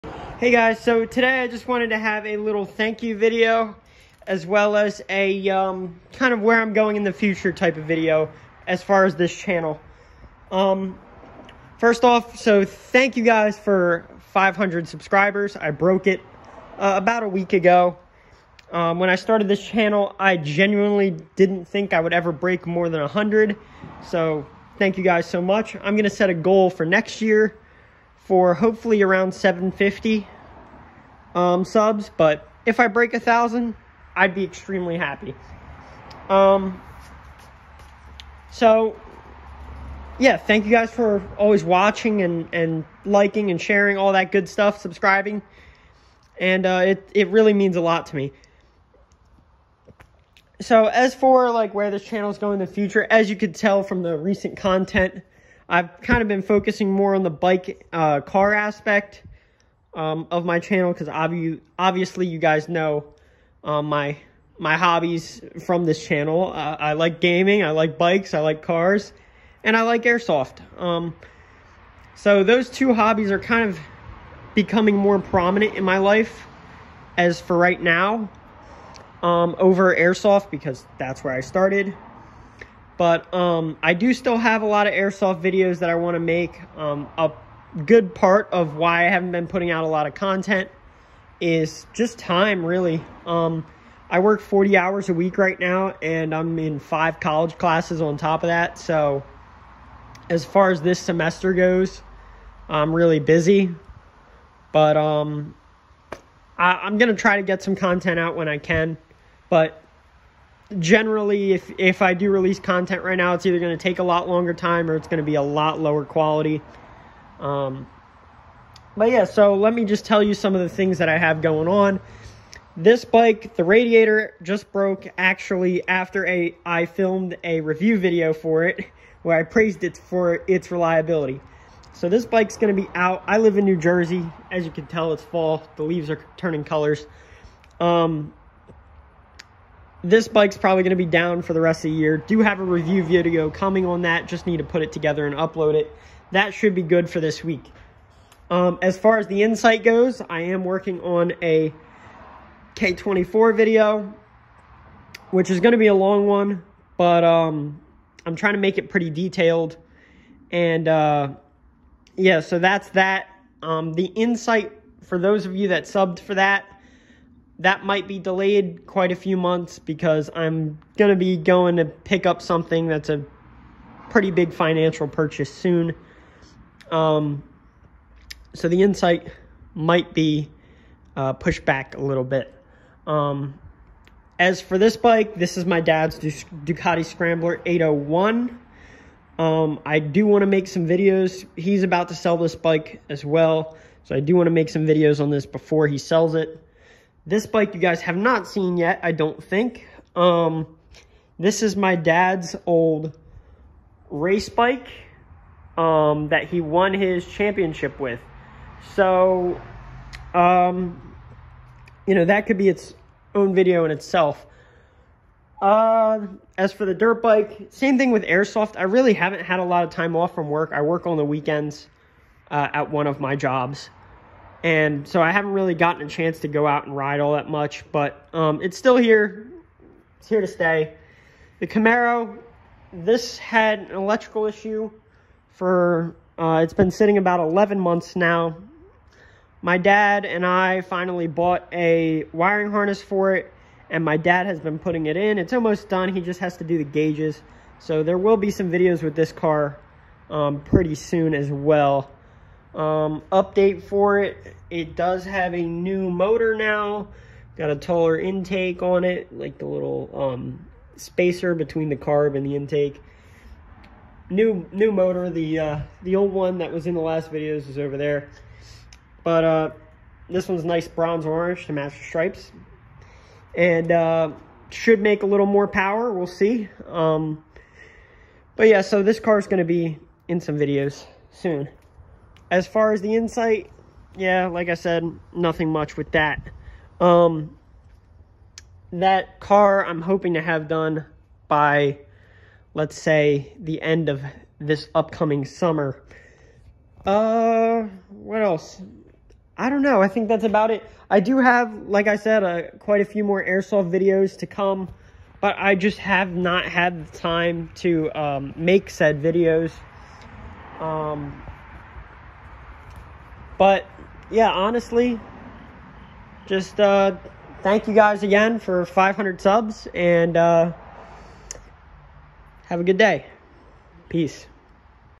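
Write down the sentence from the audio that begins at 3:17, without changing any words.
This bike you guys have not seen yet, I don't think.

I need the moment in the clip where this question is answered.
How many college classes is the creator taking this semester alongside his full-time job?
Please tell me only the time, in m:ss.
1:36.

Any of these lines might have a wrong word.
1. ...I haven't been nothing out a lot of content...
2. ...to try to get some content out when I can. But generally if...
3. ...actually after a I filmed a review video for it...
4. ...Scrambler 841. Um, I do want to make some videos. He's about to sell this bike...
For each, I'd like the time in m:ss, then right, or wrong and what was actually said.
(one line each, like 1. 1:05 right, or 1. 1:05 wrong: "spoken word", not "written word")
1. 1:29 wrong: "putting", not "nothing"
2. 1:47 right
3. 2:05 right
4. 3:07 wrong: "801", not "841".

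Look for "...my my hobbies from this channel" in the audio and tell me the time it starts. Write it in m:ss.
1:03.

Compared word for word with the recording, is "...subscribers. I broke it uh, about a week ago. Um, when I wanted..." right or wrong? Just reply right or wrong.
wrong.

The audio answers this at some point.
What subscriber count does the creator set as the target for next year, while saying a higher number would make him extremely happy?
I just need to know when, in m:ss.
0:29.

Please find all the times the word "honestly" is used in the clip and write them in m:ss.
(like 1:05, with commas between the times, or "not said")
5:14.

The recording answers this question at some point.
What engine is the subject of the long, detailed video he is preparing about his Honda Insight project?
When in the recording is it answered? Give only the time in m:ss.
2:32.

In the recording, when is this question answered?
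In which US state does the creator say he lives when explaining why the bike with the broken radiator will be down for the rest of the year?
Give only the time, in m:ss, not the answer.
2:13.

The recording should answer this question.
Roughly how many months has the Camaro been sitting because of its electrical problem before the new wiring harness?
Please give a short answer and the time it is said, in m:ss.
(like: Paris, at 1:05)
11 months, at 3:57.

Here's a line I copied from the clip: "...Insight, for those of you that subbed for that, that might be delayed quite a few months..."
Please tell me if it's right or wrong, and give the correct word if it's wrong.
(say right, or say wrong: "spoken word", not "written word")
right.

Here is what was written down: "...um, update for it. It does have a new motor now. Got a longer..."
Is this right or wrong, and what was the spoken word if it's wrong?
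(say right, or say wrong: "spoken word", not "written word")
wrong: "taller", not "longer".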